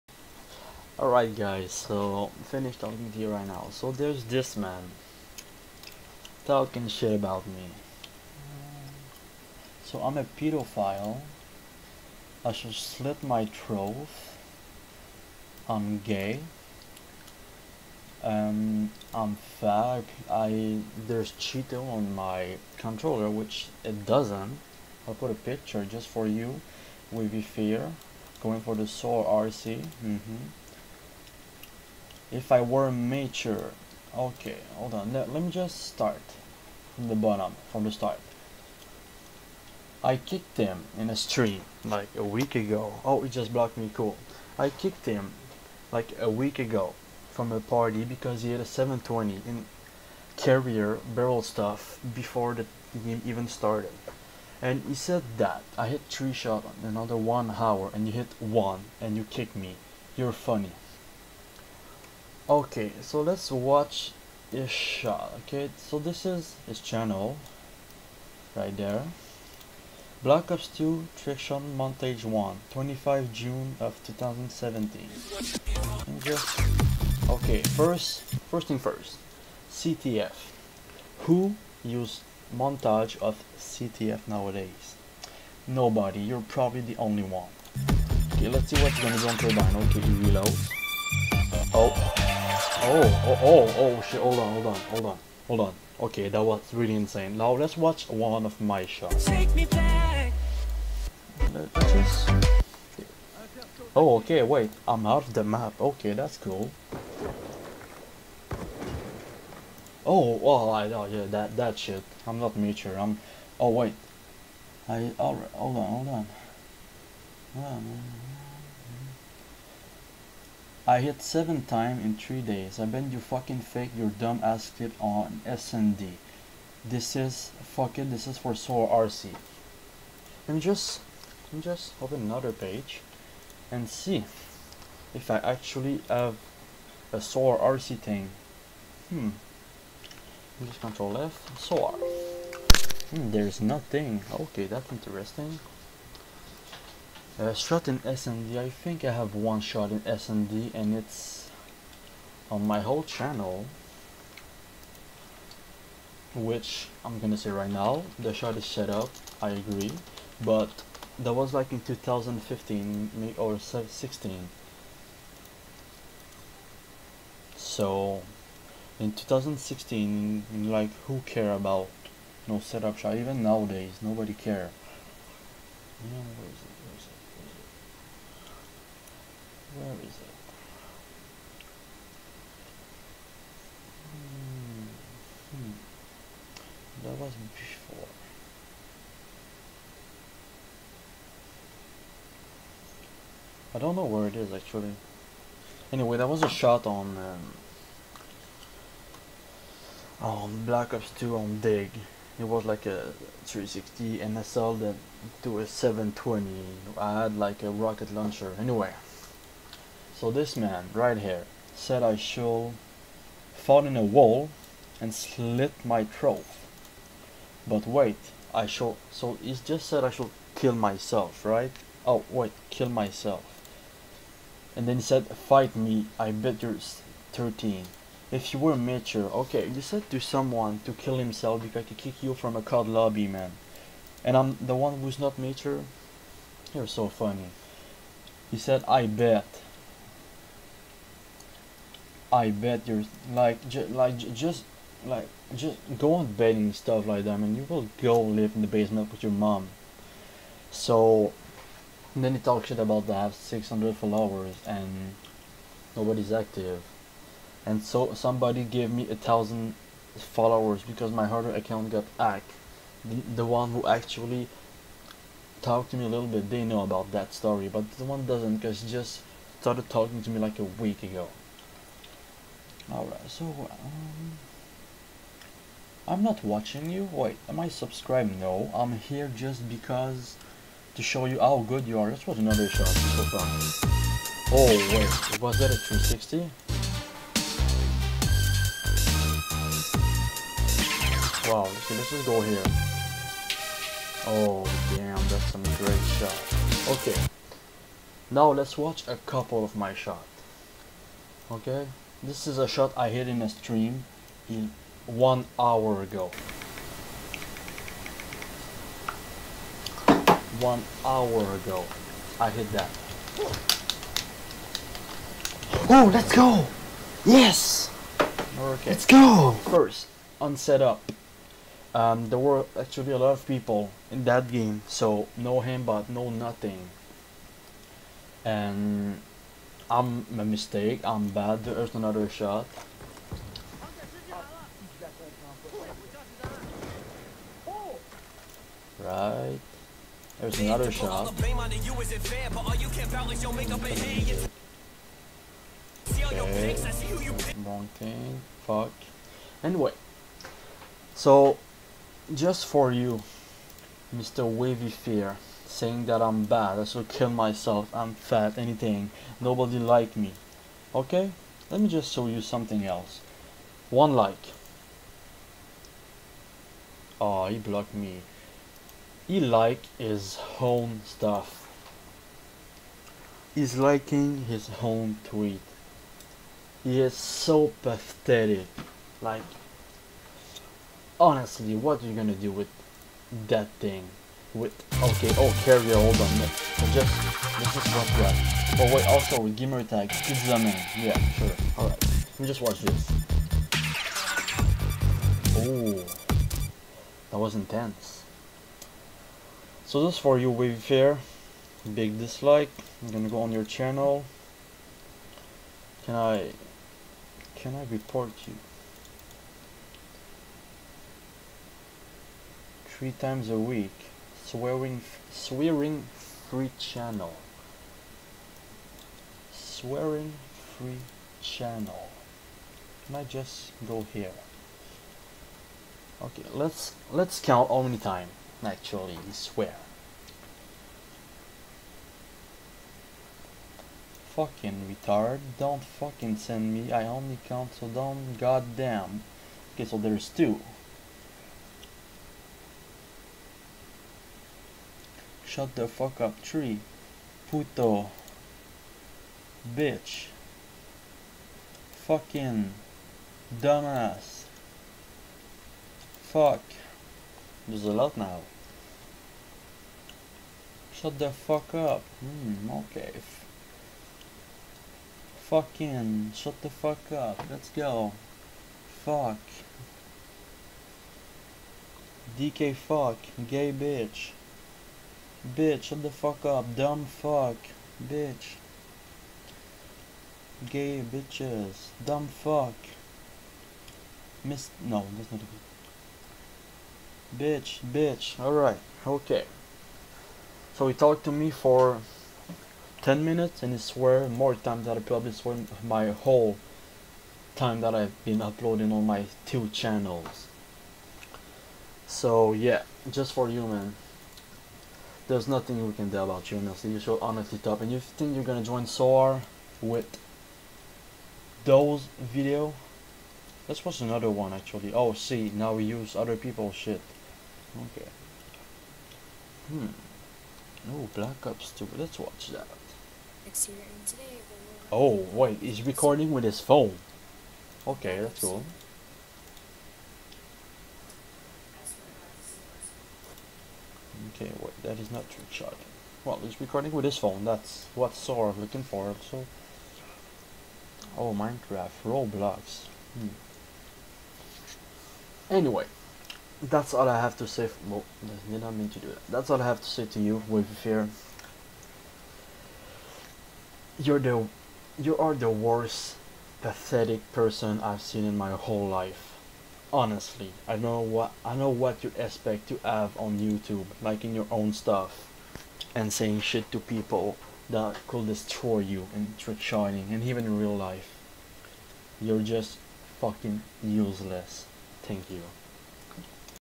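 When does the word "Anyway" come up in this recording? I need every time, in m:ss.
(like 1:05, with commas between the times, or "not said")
3:15, 3:28, 5:49, 9:05.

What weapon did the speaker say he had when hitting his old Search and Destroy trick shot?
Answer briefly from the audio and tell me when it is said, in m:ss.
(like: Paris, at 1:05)
rocket launcher, at 3:27.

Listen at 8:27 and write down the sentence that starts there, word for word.
And you think you're gonna join SOAR with those video?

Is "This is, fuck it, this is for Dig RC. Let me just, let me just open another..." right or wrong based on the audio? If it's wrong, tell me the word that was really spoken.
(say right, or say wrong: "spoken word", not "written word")
wrong: "Soul", not "Dig".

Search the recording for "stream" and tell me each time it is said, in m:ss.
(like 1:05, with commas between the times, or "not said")
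0:41, 5:03.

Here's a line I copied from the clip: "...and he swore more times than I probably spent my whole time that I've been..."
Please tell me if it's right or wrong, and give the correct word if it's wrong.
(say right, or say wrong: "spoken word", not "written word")
right.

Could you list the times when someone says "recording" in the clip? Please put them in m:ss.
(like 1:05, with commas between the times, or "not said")
8:45, 8:56.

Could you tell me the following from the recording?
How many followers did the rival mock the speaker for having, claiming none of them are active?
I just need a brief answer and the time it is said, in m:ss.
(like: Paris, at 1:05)
600, at 4:13.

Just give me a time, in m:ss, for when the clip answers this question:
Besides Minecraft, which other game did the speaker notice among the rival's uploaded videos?
9:02.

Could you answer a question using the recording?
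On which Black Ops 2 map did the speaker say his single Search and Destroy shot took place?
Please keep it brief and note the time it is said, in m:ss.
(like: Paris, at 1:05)
Dig, at 3:21.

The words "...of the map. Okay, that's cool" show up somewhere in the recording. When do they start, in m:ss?
1:45.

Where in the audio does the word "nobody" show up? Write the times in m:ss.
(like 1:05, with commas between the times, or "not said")
1:25, 2:53, 4:15, 5:59.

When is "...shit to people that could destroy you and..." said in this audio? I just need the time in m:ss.
9:26.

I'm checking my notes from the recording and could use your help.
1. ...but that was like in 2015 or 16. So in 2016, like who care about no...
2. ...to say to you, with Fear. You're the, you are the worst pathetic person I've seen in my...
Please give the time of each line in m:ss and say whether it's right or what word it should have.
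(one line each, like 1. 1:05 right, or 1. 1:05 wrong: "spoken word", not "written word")
1. 2:40 right
2. 9:09 right.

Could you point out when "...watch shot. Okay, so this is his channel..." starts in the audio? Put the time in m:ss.
1:03.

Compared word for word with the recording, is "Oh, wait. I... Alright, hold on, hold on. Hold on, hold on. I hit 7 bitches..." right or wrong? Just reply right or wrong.
wrong.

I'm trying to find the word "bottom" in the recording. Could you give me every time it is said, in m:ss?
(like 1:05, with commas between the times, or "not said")
0:37.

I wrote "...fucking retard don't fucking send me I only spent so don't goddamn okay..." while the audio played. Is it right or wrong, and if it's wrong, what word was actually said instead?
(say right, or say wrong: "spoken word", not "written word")
wrong: "count", not "spent".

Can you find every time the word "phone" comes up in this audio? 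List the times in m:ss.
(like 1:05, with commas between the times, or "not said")
8:46, 8:57.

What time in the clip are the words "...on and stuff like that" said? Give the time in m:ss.
4:06.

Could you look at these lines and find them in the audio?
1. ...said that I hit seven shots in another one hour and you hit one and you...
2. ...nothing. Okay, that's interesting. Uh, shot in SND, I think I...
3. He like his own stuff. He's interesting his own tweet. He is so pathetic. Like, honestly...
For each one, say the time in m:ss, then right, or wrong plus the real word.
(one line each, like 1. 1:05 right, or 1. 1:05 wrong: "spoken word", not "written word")
1. 0:54 wrong: "three", not "seven"
2. 2:23 right
3. 6:09 wrong: "liking", not "interesting".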